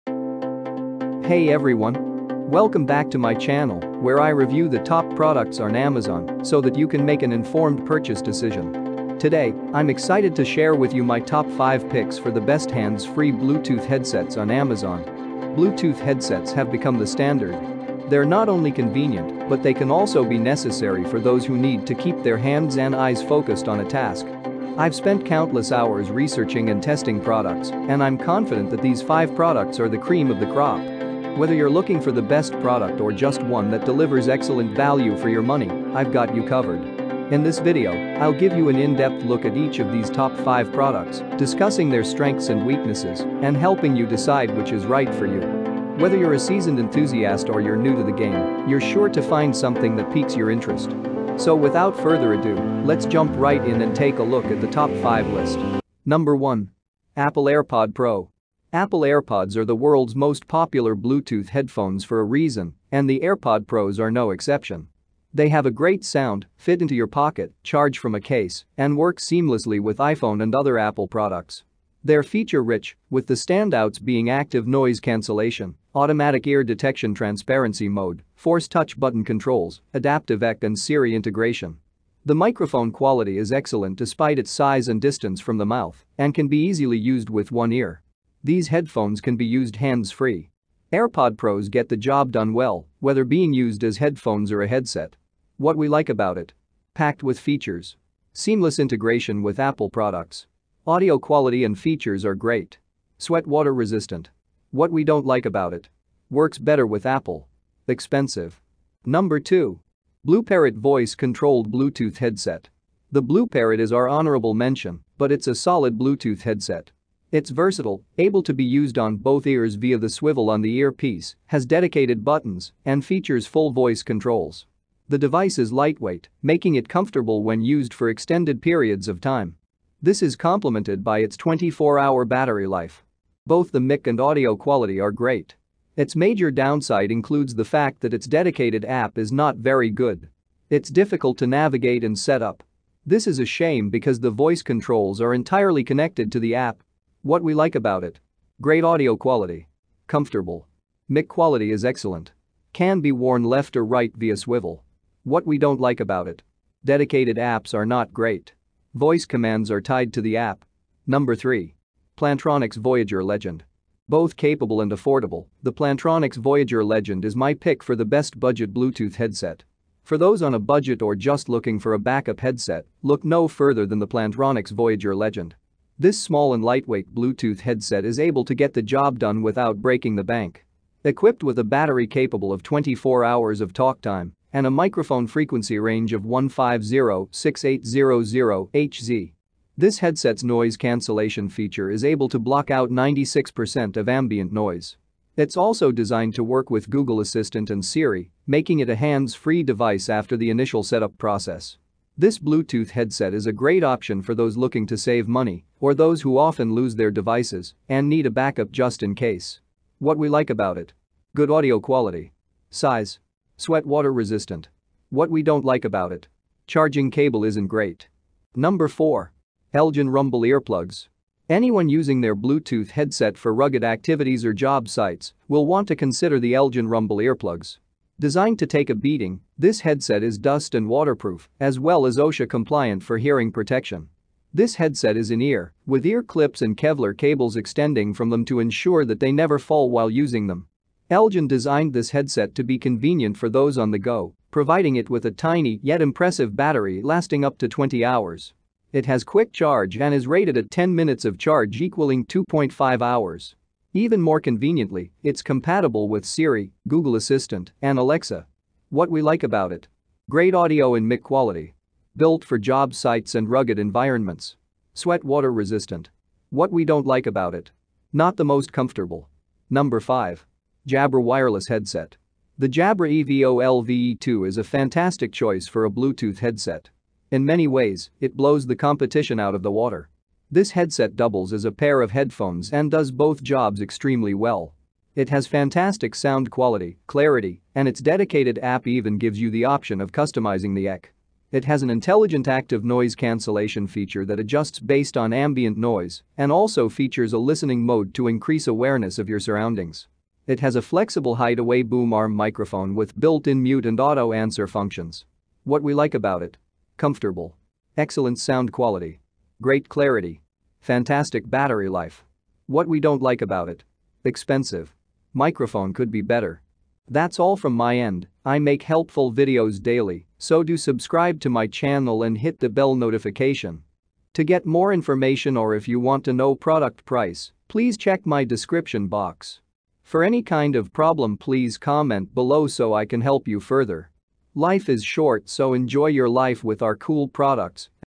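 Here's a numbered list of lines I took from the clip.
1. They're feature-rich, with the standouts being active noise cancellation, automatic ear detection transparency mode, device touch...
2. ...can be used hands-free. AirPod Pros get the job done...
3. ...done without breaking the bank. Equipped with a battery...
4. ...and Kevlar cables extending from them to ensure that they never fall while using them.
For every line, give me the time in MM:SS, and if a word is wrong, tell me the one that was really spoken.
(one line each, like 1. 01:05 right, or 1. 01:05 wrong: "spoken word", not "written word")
1. 01:12 wrong: "force", not "device"
2. 01:29 right
3. 02:59 right
4. 03:56 right.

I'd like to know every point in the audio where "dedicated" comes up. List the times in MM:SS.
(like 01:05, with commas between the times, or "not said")
02:01, 02:18, 02:36, 04:48.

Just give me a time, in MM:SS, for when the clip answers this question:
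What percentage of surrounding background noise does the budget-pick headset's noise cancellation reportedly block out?
03:12.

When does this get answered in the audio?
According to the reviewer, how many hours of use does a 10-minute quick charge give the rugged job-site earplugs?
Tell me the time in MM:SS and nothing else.
04:12.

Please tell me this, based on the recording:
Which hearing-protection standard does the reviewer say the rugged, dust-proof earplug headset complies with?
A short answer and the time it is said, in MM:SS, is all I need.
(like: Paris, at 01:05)
OSHA, at 03:52.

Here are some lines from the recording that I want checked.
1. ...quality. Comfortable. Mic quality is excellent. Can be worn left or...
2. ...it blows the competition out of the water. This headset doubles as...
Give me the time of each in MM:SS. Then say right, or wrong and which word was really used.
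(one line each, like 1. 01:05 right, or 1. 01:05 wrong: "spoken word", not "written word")
1. 02:29 right
2. 04:38 right.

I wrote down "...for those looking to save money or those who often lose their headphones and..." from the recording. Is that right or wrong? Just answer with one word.
wrong.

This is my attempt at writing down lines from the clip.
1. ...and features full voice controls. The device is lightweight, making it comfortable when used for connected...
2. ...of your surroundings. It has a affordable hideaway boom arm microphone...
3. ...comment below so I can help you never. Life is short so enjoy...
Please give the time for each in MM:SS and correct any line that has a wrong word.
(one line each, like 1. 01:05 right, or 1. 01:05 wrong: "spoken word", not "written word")
1. 02:02 wrong: "extended", not "connected"
2. 04:59 wrong: "flexible", not "affordable"
3. 05:31 wrong: "further", not "never".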